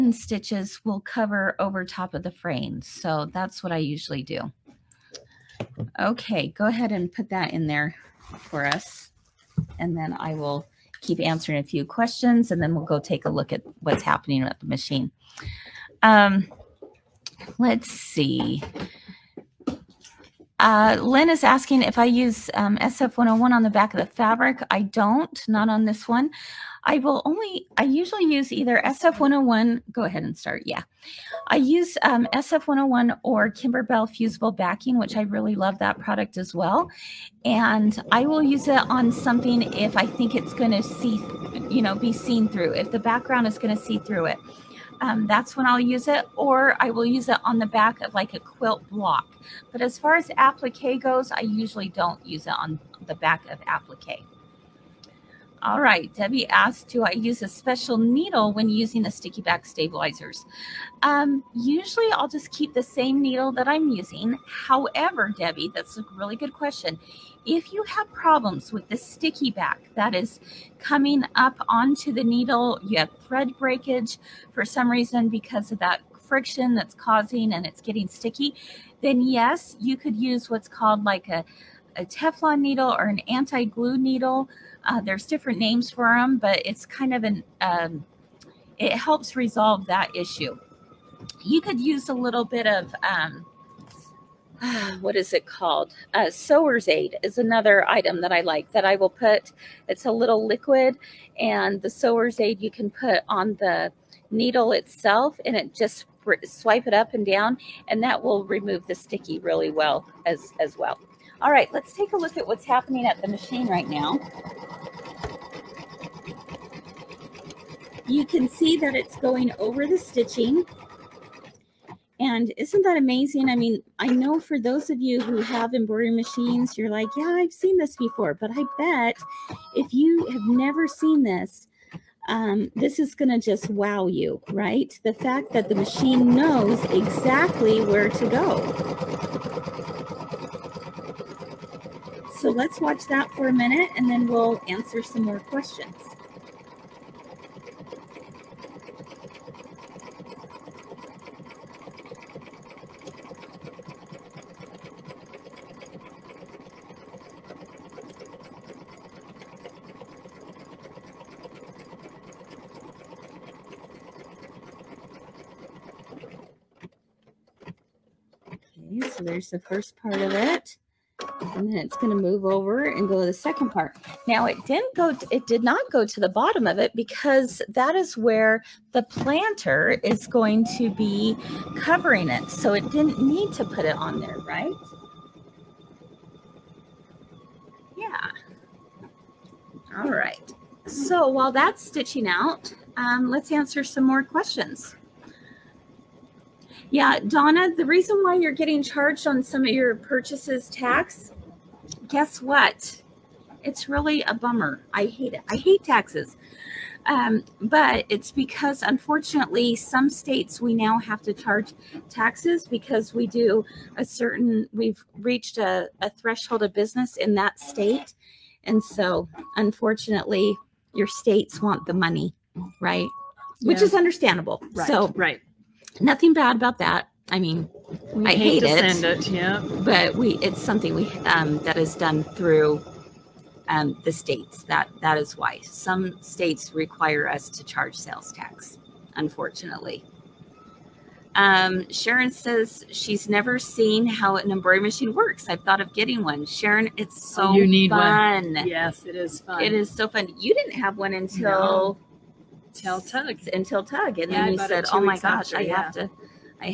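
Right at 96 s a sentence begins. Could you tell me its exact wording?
Uh, Sewer's Aid is another item that I like that I will put.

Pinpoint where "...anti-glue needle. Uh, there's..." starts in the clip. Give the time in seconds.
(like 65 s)
83 s.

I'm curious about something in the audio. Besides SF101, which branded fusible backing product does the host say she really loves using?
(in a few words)
Kimberbell Fusible Backing.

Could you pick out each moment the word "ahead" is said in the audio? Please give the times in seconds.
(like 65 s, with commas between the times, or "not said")
6 s, 30 s.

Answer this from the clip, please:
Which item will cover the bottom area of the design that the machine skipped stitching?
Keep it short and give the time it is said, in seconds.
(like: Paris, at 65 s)
the planter, at 178 s.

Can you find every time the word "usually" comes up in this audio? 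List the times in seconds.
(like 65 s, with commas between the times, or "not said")
3 s, 27 s, 51 s, 61 s.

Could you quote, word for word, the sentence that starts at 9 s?
And then I will keep answering a few questions, and then we'll go take a look at what's happening at the machine.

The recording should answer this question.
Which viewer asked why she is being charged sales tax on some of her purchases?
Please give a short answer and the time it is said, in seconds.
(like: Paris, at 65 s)
Donna, at 197 s.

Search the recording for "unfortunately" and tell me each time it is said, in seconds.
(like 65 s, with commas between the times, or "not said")
208 s, 219 s, 239 s.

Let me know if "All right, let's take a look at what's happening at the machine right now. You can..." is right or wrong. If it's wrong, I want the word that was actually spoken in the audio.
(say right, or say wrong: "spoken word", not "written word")
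right.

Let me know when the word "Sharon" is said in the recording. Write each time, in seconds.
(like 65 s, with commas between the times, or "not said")
241 s, 246 s.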